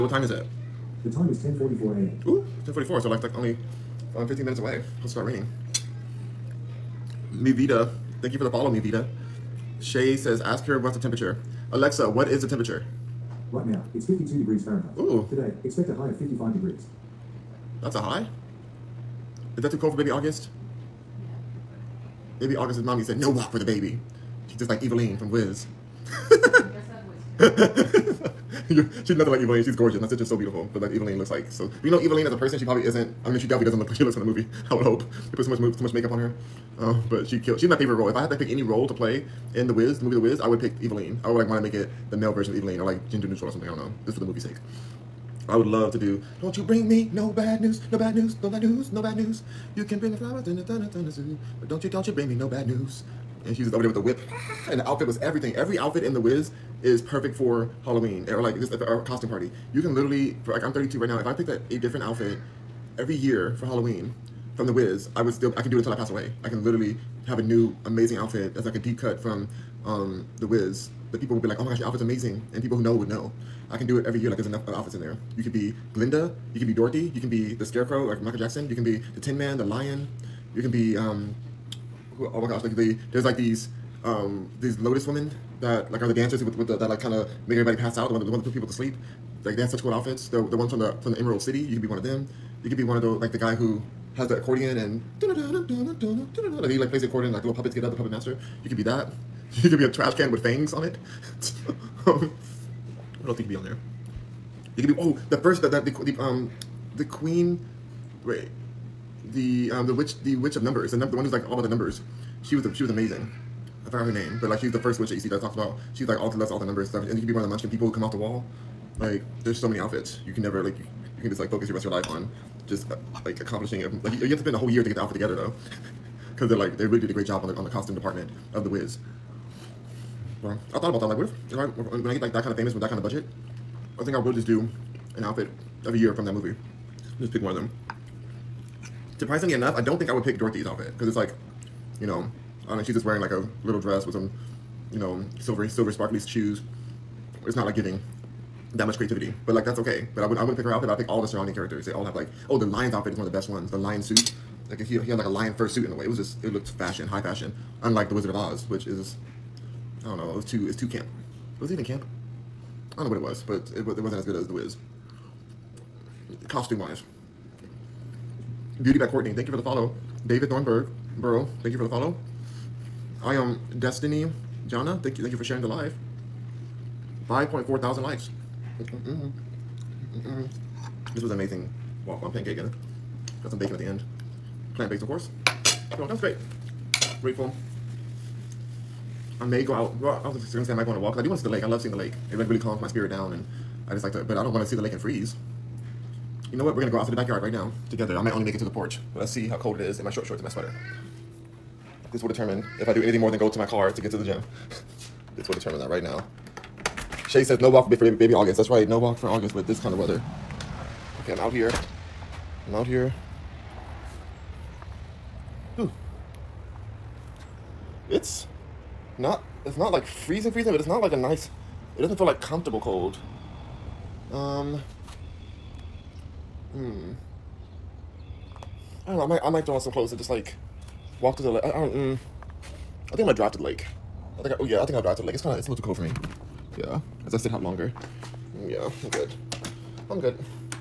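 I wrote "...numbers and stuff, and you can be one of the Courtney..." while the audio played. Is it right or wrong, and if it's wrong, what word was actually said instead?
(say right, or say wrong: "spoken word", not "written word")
wrong: "Munchkin", not "Courtney".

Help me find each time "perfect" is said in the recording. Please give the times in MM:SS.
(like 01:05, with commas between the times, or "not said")
00:57.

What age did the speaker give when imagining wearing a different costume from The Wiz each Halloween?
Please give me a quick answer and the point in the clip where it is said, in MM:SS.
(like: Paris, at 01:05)
32, at 01:00.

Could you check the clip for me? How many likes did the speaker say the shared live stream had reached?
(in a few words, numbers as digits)
5.4 thousand.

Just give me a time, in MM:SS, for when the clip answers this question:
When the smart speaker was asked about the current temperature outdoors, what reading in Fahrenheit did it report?
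00:14.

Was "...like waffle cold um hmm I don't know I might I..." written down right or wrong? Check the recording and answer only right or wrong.
wrong.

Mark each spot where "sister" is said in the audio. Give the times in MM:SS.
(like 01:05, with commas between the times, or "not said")
00:30.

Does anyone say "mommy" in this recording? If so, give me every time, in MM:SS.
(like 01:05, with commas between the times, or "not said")
00:22.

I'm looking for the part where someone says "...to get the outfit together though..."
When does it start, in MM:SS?
02:04.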